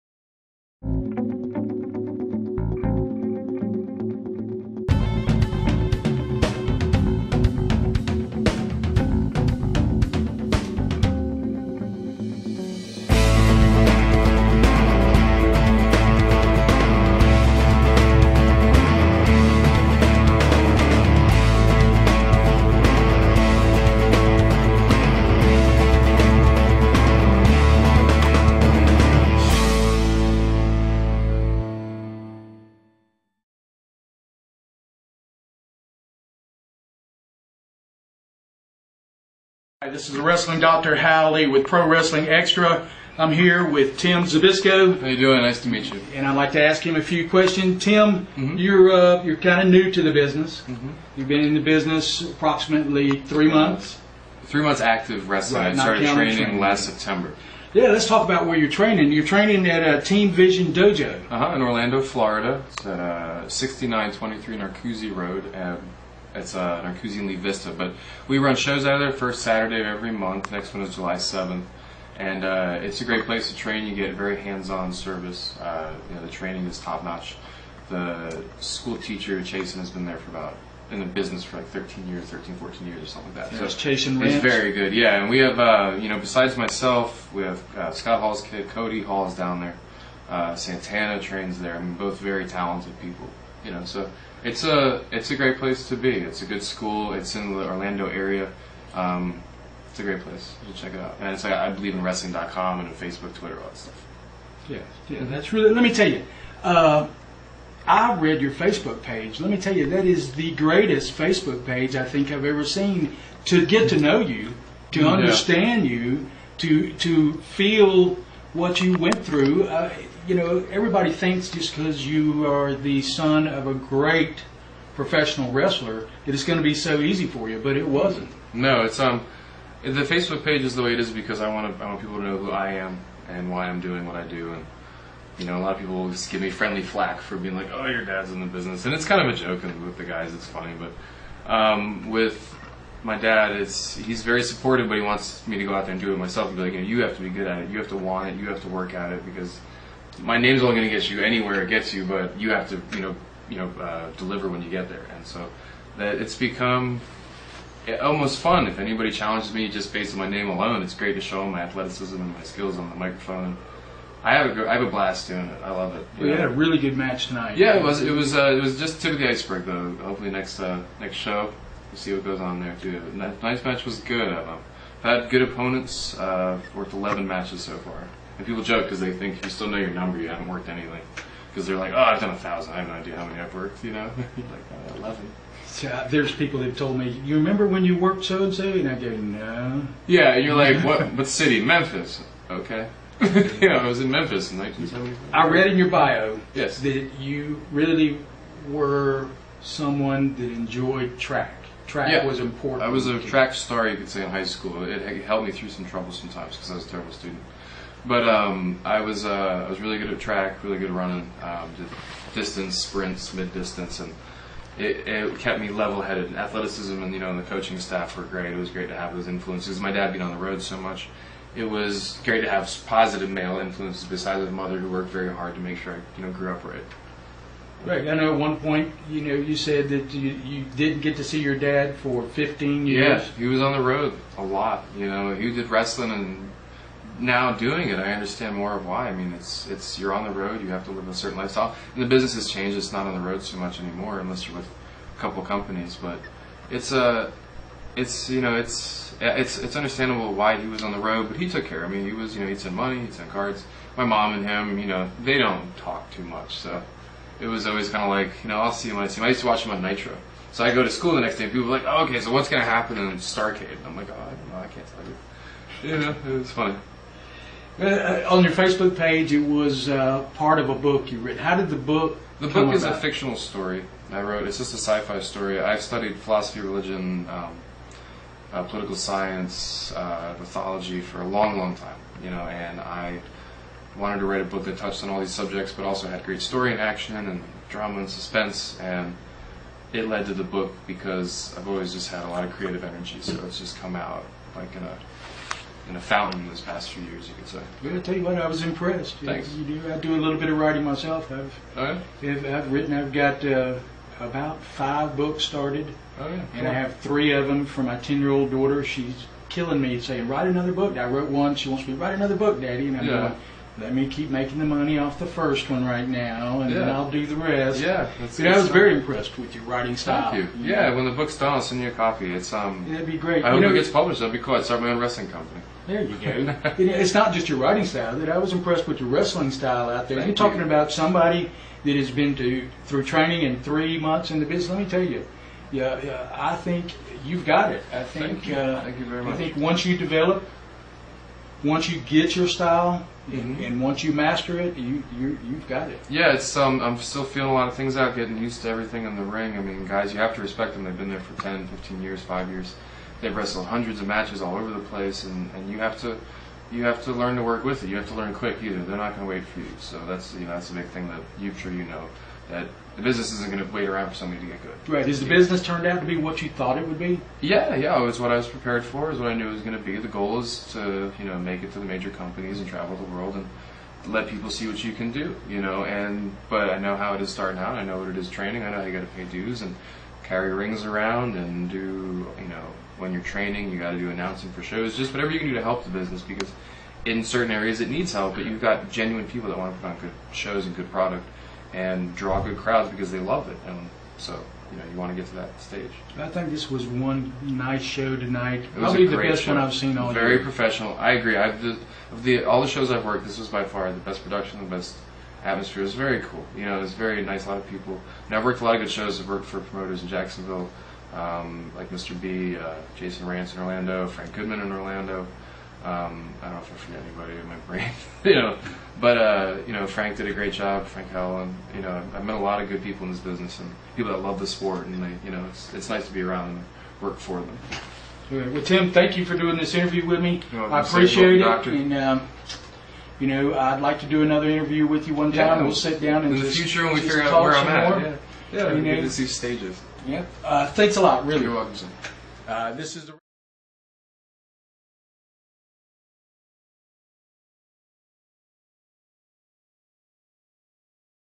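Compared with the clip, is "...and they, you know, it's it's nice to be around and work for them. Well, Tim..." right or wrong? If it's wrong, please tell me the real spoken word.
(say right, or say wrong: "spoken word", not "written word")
right.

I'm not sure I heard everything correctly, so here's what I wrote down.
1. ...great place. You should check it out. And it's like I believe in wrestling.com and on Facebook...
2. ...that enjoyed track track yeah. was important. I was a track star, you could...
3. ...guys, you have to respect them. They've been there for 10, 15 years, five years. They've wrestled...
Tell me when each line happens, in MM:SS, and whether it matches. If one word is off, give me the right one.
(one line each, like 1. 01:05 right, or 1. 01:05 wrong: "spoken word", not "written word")
1. 01:40 right
2. 03:20 right
3. 05:49 right.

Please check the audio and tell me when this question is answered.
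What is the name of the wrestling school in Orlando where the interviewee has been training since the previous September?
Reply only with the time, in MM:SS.
01:00.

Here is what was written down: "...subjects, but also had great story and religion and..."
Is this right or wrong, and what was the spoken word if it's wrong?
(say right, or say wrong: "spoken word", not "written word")
wrong: "action", not "religion".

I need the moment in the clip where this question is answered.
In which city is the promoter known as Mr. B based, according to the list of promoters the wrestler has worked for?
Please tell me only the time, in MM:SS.
06:50.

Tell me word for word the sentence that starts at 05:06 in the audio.
and I have three of them for my ten-year-old daughter.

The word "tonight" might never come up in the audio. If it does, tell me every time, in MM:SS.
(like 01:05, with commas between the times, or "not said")
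02:47, 06:38.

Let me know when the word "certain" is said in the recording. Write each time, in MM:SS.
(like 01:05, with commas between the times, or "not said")
04:01, 06:27.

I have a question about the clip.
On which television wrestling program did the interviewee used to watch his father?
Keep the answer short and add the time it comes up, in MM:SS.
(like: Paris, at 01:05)
Nitro, at 04:19.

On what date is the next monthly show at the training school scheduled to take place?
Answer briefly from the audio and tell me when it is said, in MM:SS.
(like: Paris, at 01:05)
July 7th, at 01:10.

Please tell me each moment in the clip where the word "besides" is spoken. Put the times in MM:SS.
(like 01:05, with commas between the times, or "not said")
01:26, 03:44.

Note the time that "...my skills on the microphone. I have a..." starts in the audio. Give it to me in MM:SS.
02:42.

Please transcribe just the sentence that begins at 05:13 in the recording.
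going let me keep making the money off the first one right now, and yeah.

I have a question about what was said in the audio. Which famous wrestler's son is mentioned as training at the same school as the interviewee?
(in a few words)
Scott Hall.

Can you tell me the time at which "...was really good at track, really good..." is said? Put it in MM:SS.
03:29.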